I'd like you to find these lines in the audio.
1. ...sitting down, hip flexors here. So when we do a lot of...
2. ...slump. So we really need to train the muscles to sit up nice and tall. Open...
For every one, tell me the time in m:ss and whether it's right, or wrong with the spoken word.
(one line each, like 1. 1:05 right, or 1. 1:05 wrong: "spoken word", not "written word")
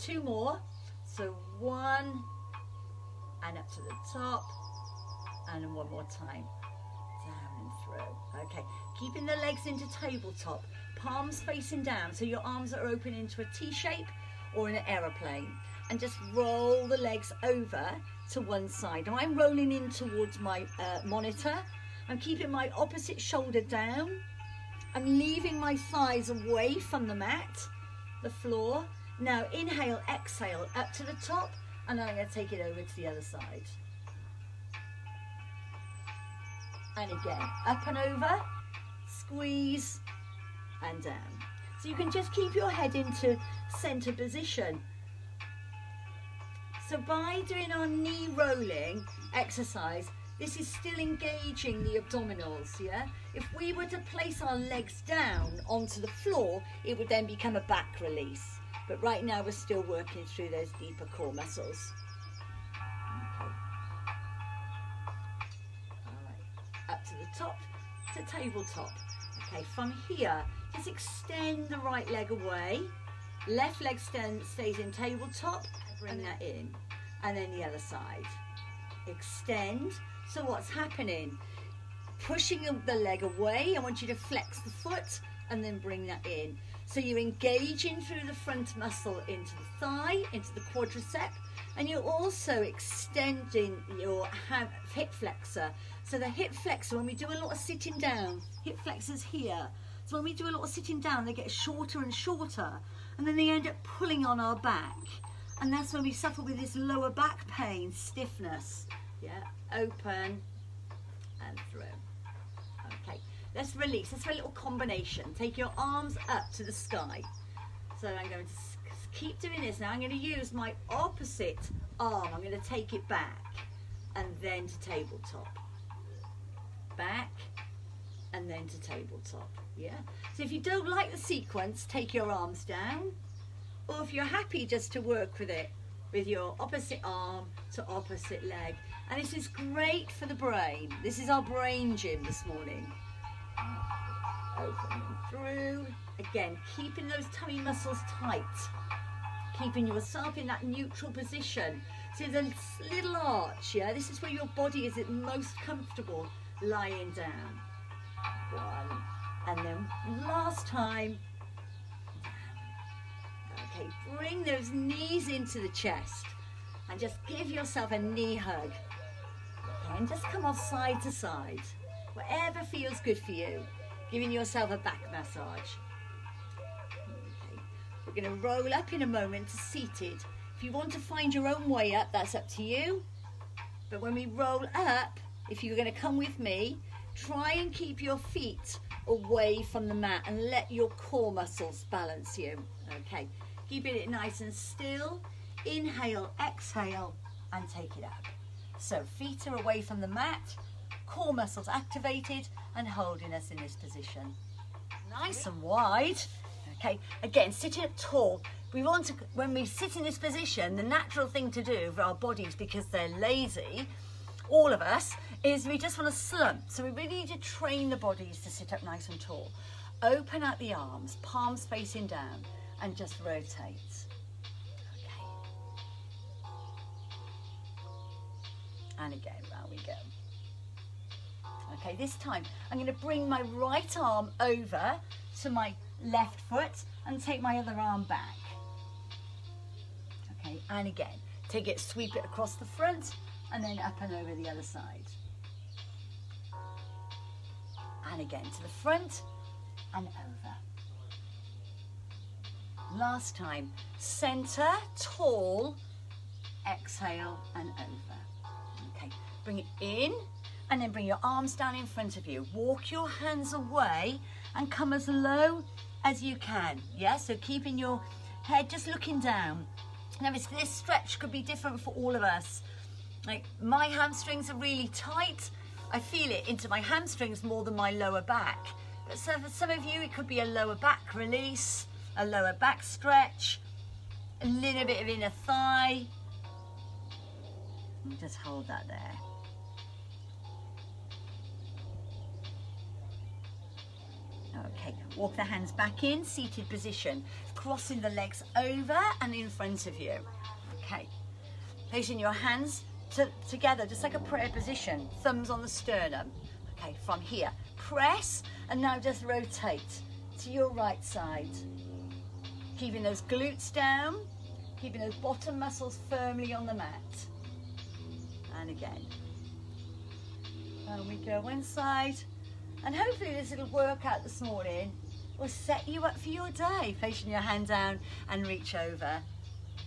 1. 1:37 right
2. 3:36 wrong: "bodies", not "muscles".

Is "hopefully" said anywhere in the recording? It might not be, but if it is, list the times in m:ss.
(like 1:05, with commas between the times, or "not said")
5:22.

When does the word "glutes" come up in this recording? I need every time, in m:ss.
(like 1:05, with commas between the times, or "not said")
5:13.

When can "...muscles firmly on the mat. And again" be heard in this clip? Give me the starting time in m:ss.
5:15.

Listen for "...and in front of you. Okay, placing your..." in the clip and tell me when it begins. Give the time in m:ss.
4:59.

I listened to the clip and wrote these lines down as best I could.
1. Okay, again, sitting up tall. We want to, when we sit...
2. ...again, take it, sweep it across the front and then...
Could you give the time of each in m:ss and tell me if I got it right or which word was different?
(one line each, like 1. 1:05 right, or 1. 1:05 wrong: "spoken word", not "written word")
1. 3:26 right
2. 4:00 right.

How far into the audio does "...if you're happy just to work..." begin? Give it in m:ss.
2:14.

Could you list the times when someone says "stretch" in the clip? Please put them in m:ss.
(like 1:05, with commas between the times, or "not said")
4:30, 4:42.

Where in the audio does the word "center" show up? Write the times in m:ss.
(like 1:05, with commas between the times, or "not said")
0:43, 4:13.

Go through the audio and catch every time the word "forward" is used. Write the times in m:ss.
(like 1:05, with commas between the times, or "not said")
not said.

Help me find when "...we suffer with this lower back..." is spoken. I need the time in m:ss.
1:46.